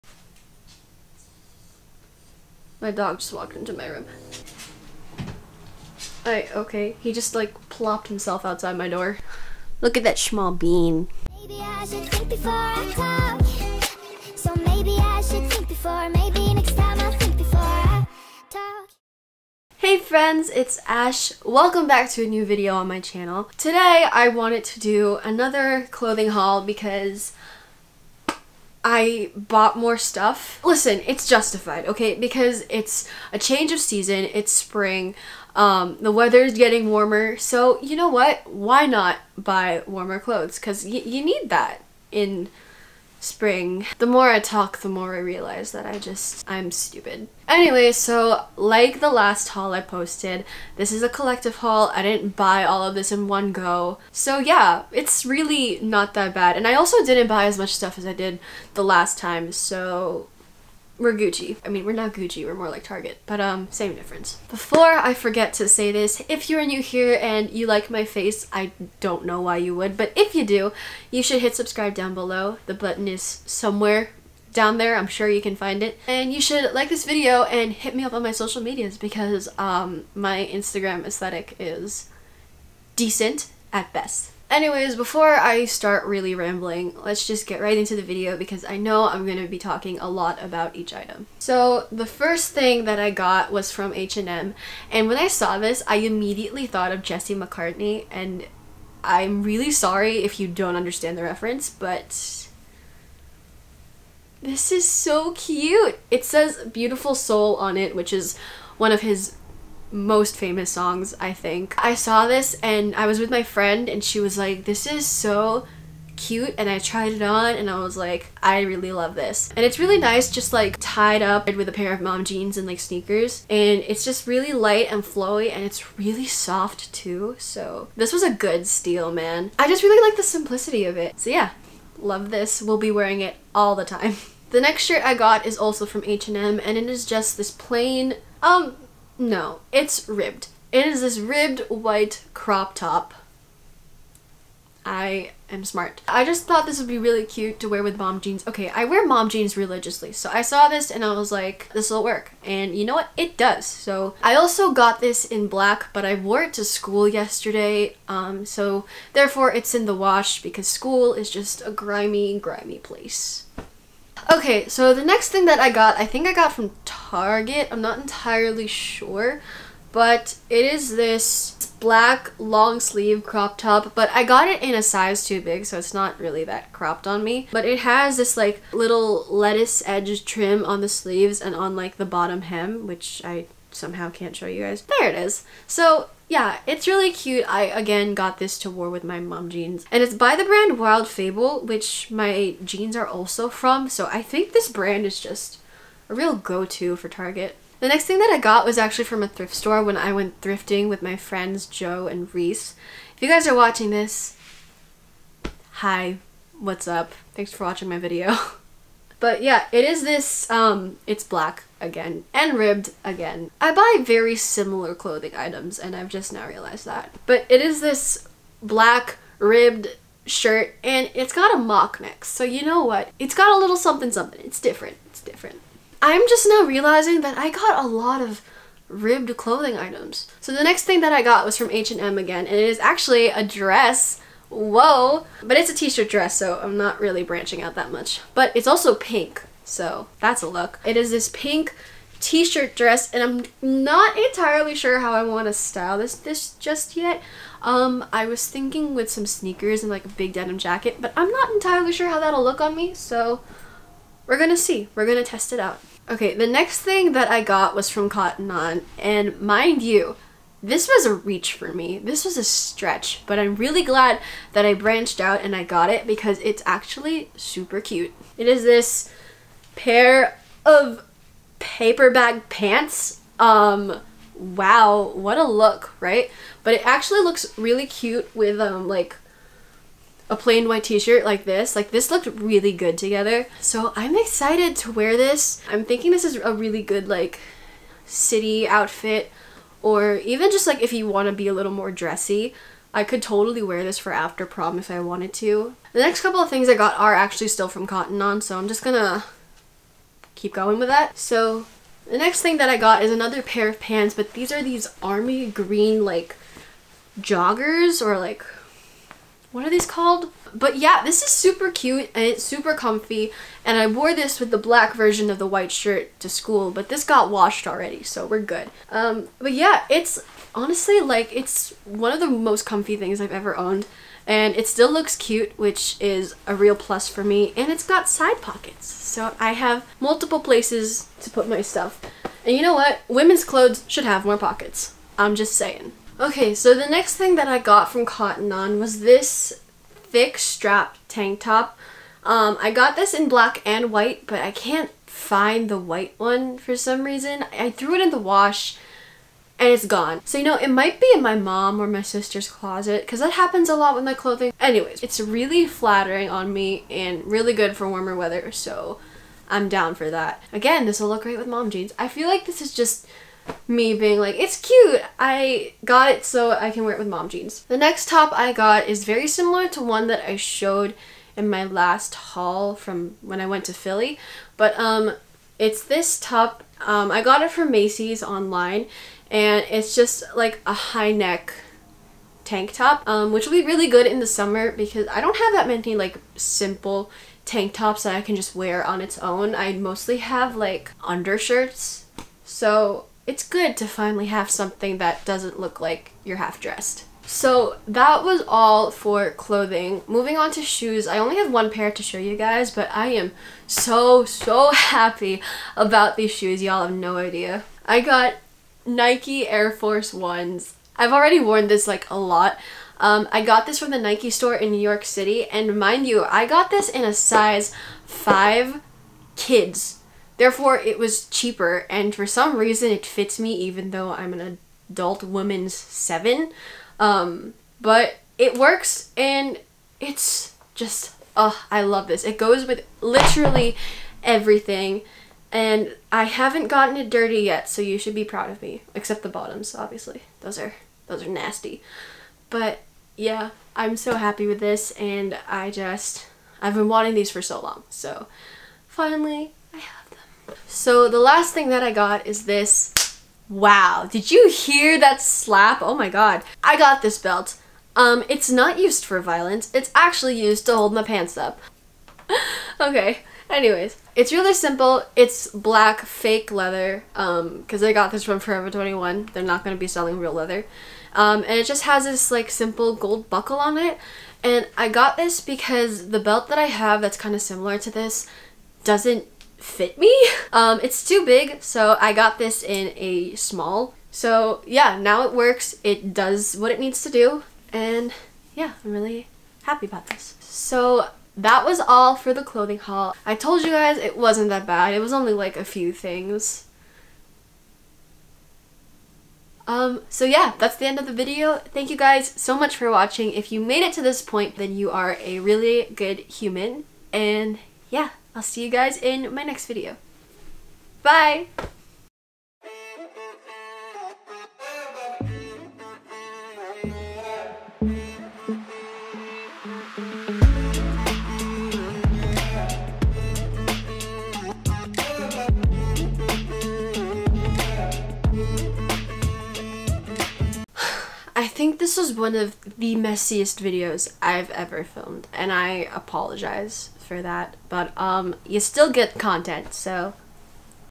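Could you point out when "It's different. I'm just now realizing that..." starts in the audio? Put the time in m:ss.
3:45.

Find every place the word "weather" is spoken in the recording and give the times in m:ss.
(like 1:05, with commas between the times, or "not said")
0:36, 5:58.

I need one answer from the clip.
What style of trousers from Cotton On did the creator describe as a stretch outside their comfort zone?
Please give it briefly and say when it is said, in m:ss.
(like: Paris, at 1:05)
Paper bag pants, at 4:31.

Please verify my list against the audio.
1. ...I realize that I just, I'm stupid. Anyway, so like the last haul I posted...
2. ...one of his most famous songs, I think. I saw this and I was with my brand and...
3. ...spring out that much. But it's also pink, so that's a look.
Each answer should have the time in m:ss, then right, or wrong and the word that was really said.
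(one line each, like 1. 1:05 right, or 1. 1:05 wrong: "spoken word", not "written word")
1. 0:45 right
2. 1:48 wrong: "friend", not "brand"
3. 3:57 wrong: "branching", not "spring".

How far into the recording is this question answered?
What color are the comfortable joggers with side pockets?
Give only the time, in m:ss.
5:05.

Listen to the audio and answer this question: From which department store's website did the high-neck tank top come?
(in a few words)
Macy's.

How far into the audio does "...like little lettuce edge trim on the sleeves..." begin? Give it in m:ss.
2:58.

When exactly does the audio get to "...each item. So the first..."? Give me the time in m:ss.
1:30.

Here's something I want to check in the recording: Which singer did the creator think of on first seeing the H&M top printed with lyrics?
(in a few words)
Jesse McCartney.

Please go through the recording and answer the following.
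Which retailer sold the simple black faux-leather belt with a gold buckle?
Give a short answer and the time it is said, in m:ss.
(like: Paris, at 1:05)
Forever 21, at 7:48.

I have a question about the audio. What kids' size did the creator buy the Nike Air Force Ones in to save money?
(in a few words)
5.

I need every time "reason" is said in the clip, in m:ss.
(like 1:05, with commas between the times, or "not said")
5:47, 7:02.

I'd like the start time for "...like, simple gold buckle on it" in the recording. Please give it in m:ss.
7:52.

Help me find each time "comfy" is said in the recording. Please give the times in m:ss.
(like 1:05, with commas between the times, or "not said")
5:12, 5:22.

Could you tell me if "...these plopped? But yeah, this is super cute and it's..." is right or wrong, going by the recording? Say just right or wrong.
wrong.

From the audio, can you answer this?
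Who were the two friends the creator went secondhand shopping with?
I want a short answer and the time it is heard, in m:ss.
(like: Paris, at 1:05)
Joe and Reese, at 3:21.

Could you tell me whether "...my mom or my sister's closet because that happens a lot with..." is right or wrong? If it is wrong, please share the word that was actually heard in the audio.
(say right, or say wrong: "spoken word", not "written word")
right.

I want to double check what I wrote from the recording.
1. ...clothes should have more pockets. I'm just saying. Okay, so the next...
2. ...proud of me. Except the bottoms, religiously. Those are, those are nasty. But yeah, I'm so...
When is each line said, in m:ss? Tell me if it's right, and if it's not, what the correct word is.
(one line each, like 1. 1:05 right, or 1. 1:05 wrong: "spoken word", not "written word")
1. 5:33 right
2. 7:18 wrong: "obviously", not "religiously".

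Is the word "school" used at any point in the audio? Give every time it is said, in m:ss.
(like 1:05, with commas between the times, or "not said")
2:36, 2:40, 5:16.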